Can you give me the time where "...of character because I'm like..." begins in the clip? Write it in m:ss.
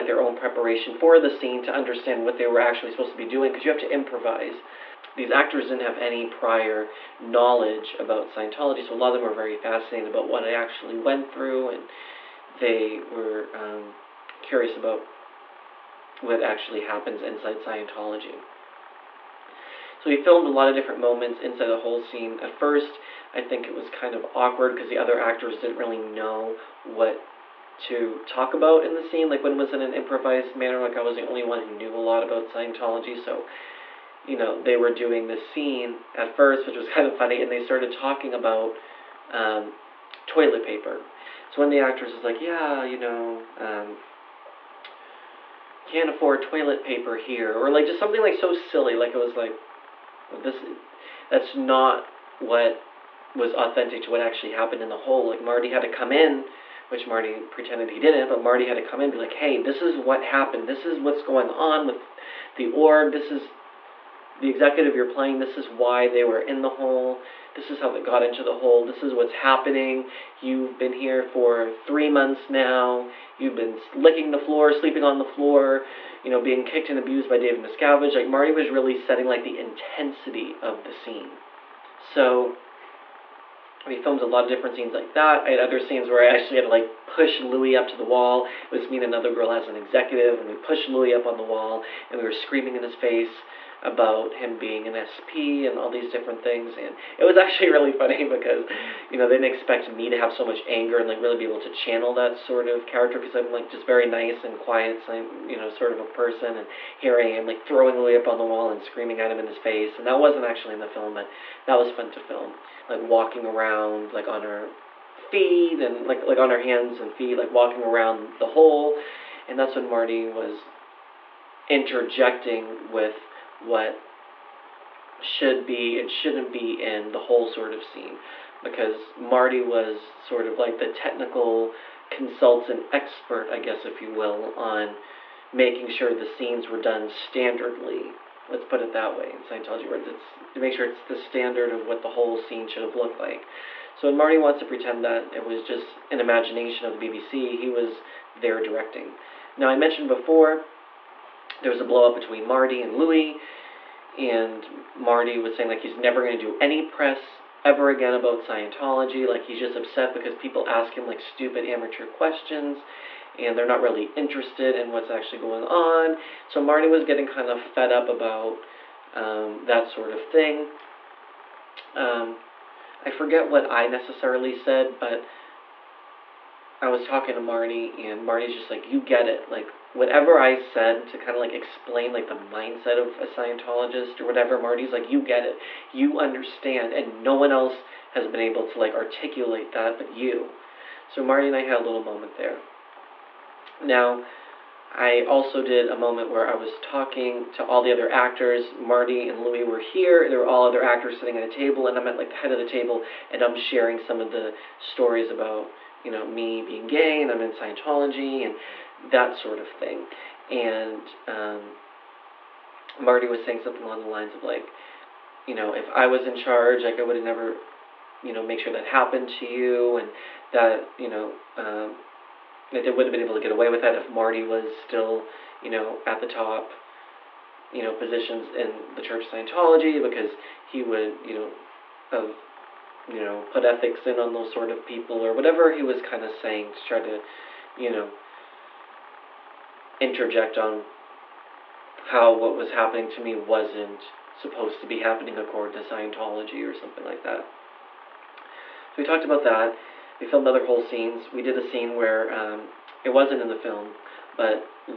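1:42.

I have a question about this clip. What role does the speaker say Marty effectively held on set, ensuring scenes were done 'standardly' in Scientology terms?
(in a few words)
technical consultant.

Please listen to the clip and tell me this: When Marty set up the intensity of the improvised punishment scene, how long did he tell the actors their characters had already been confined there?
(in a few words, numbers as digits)
3 months.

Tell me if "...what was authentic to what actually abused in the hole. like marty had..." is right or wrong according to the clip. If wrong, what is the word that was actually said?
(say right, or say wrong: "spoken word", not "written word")
wrong: "happened", not "abused".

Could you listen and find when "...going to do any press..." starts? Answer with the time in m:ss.
2:36.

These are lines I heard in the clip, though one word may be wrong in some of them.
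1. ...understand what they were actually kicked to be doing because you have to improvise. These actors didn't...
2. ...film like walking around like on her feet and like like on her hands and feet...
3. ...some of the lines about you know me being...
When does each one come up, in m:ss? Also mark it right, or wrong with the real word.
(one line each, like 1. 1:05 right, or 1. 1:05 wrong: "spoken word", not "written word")
1. 0:01 wrong: "supposed", not "kicked"
2. 1:52 right
3. 3:23 wrong: "stories", not "lines".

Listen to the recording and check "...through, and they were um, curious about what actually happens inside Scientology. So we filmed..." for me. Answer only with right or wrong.
right.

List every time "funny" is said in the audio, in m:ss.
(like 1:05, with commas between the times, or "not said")
0:37, 1:37.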